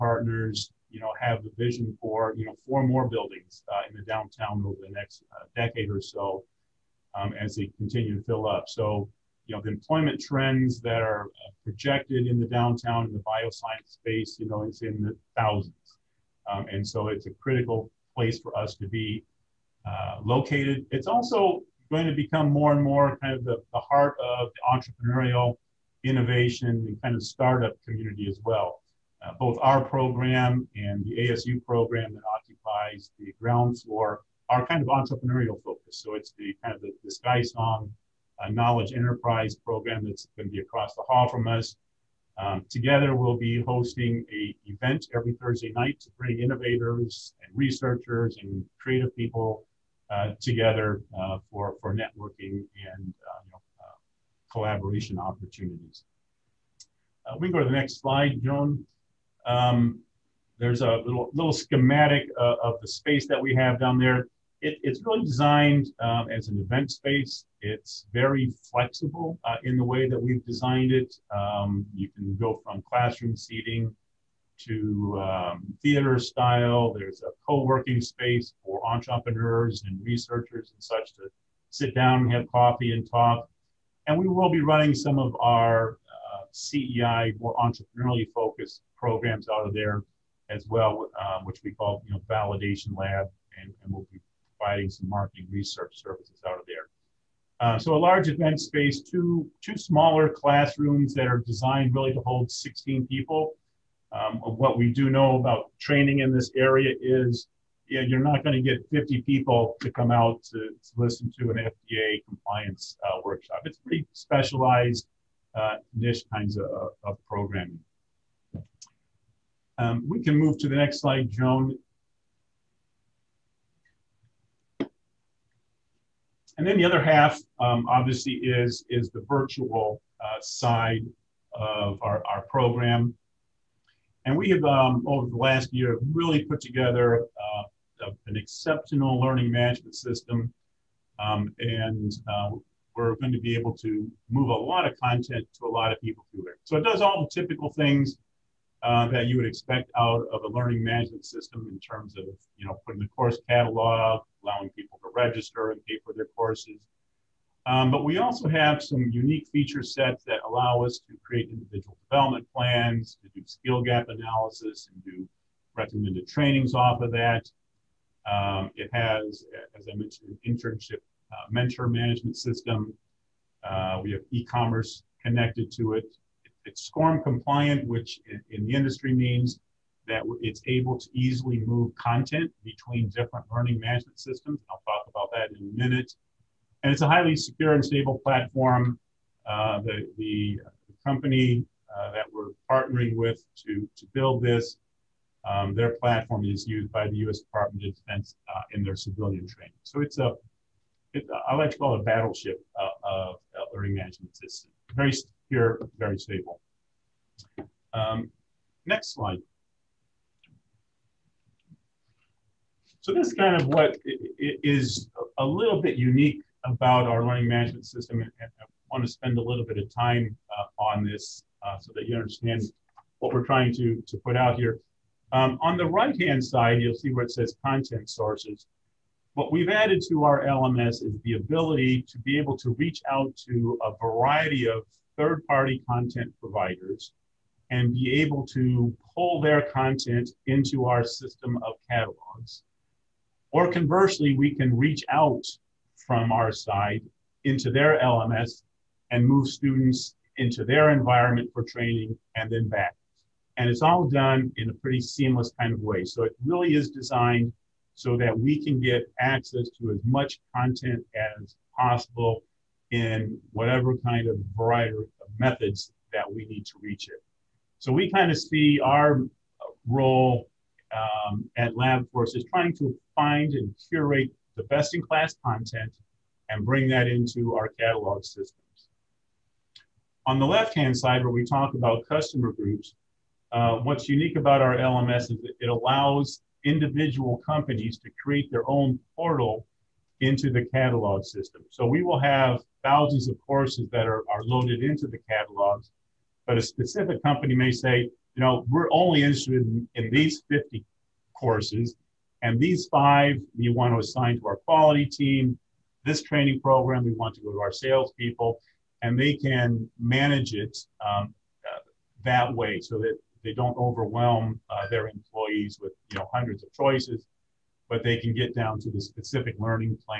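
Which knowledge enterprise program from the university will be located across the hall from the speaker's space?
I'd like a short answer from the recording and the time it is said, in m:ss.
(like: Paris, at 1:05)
SkySong, at 0:37.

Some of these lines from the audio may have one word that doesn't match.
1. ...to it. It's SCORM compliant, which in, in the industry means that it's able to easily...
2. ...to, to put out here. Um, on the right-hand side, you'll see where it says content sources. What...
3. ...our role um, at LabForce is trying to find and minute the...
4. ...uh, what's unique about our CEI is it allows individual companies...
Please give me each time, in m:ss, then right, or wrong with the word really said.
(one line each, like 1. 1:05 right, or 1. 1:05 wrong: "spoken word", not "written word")
1. 2:55 right
2. 3:43 right
3. 4:28 wrong: "curate", not "minute"
4. 4:43 wrong: "LMS", not "CEI".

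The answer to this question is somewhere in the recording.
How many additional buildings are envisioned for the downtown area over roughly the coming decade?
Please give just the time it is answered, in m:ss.
0:02.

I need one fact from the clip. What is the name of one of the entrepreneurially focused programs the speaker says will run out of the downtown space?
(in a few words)
validation lab.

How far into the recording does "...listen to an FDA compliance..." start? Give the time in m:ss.
1:50.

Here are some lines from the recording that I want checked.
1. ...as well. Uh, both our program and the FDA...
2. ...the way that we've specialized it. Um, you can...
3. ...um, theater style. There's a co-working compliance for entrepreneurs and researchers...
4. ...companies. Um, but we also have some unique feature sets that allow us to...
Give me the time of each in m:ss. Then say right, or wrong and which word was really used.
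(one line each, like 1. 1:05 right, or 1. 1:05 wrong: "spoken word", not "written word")
1. 0:28 wrong: "ASU", not "FDA"
2. 1:09 wrong: "designed", not "specialized"
3. 1:15 wrong: "space", not "compliance"
4. 2:36 wrong: "courses", not "companies".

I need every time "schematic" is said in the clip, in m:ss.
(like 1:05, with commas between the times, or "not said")
1:01.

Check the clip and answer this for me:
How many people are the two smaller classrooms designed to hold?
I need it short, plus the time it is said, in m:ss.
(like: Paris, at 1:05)
16, at 1:42.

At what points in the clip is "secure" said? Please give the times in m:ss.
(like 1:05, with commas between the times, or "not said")
3:07, 3:25.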